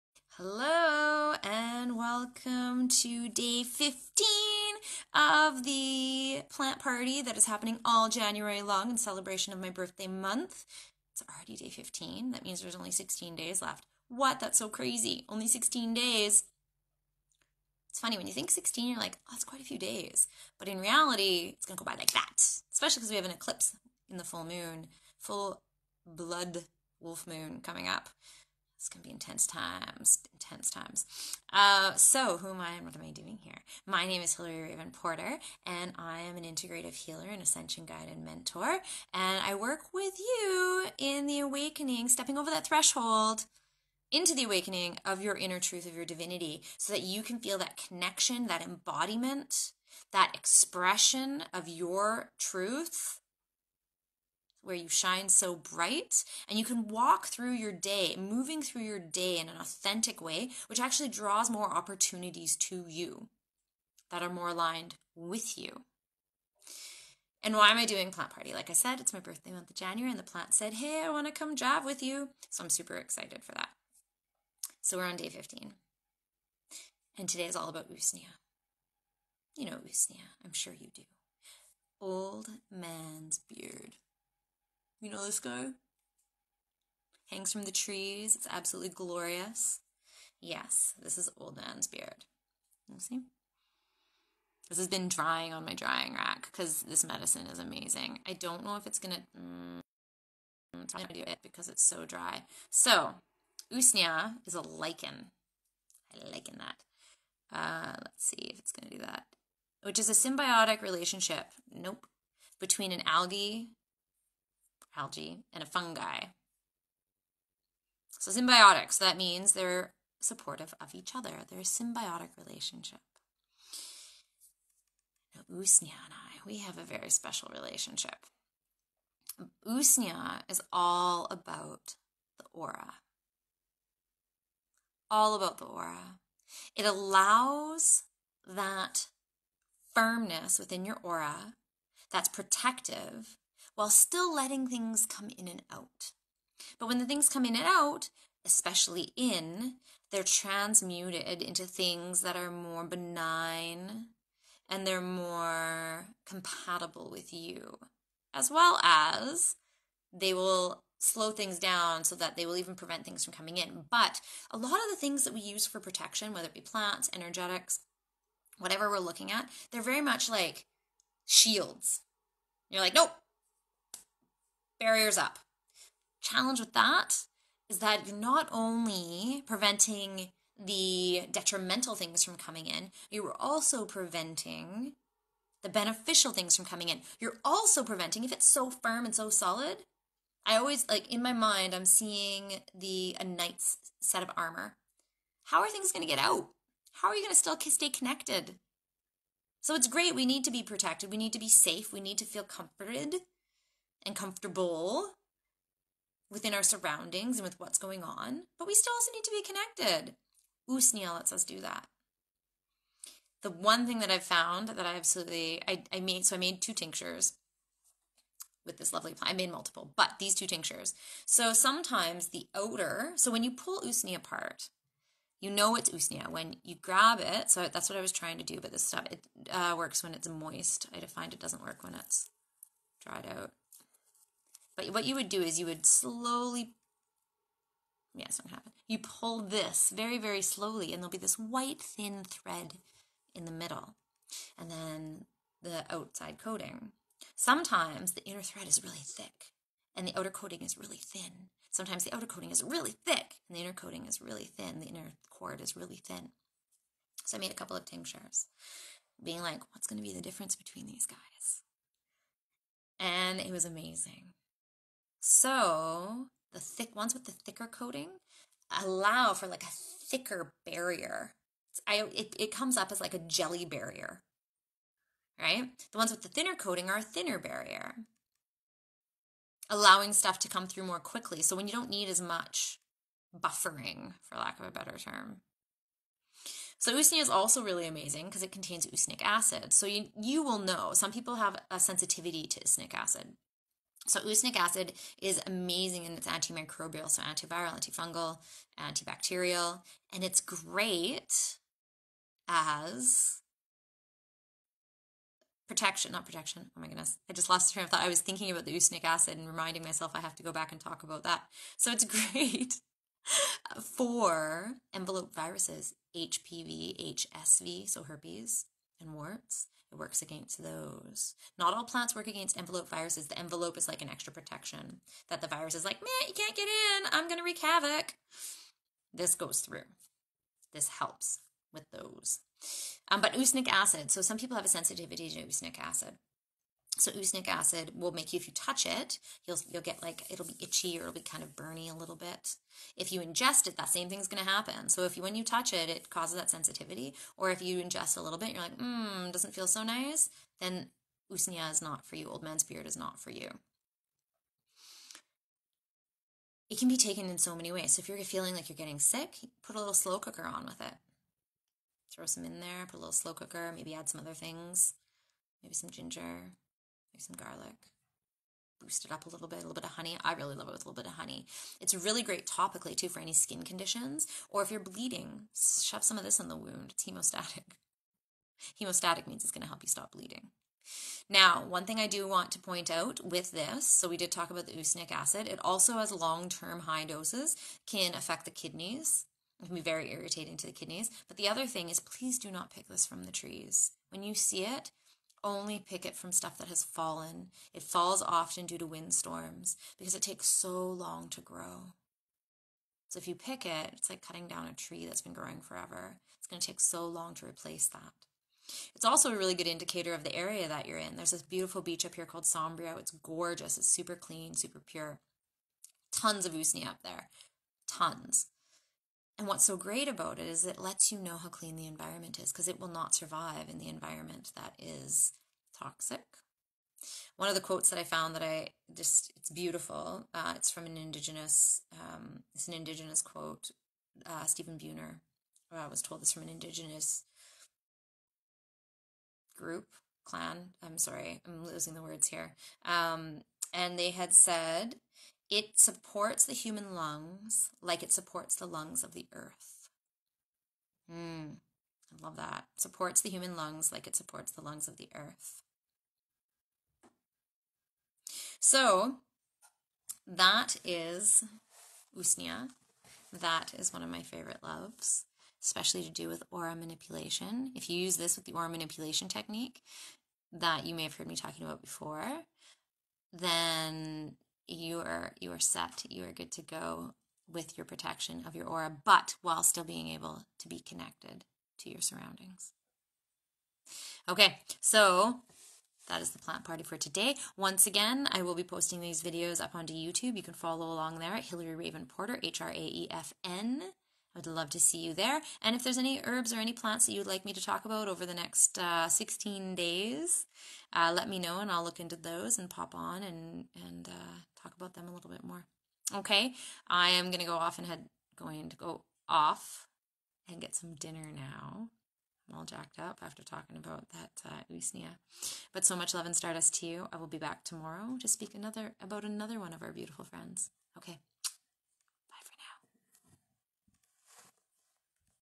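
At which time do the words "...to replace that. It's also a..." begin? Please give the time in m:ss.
6:47.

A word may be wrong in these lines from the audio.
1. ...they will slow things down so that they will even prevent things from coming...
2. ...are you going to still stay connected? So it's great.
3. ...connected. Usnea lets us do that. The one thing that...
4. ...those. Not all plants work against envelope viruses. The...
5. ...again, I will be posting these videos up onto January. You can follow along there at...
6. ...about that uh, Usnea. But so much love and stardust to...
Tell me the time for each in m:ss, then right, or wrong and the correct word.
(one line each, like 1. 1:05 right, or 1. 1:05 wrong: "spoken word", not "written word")
1. 2:40 right
2. 3:17 right
3. 3:29 right
4. 5:20 right
5. 8:07 wrong: "YouTube", not "January"
6. 8:33 right.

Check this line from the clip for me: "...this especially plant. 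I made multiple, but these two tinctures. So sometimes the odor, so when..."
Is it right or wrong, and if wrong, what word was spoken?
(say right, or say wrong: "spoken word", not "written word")
wrong: "lovely", not "especially".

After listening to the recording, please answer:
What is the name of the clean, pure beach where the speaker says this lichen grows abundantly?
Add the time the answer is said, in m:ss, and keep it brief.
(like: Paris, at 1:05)
Sombrio, at 6:52.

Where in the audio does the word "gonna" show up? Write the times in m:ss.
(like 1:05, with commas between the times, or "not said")
1:38, 1:48, 8:27.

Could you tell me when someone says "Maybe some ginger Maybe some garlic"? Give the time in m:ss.
6:05.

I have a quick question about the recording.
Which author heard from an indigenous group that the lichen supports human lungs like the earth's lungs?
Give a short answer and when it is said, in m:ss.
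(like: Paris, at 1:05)
Stephen Buhner, at 7:14.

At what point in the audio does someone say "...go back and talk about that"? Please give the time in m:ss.
5:10.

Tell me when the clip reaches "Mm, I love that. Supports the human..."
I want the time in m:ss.
7:31.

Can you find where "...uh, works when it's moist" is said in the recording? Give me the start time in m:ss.
3:49.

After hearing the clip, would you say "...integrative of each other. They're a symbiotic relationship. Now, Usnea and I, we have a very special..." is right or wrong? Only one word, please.
wrong.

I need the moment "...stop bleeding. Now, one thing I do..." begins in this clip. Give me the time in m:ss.
6:19.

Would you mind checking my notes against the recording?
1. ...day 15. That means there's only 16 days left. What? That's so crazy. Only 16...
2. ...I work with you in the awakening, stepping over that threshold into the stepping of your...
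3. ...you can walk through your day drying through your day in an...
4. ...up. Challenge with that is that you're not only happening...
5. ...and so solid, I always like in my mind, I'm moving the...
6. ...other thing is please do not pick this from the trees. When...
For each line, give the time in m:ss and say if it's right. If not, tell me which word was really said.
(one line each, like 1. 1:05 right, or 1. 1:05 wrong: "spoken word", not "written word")
1. 0:11 right
2. 0:39 wrong: "awakening", not "stepping"
3. 0:56 wrong: "moving", not "drying"
4. 2:55 wrong: "preventing", not "happening"
5. 3:09 wrong: "seeing", not "moving"
6. 6:31 right.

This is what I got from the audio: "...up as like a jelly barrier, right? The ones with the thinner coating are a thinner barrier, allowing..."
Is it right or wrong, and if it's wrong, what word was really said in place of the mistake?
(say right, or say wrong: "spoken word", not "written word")
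right.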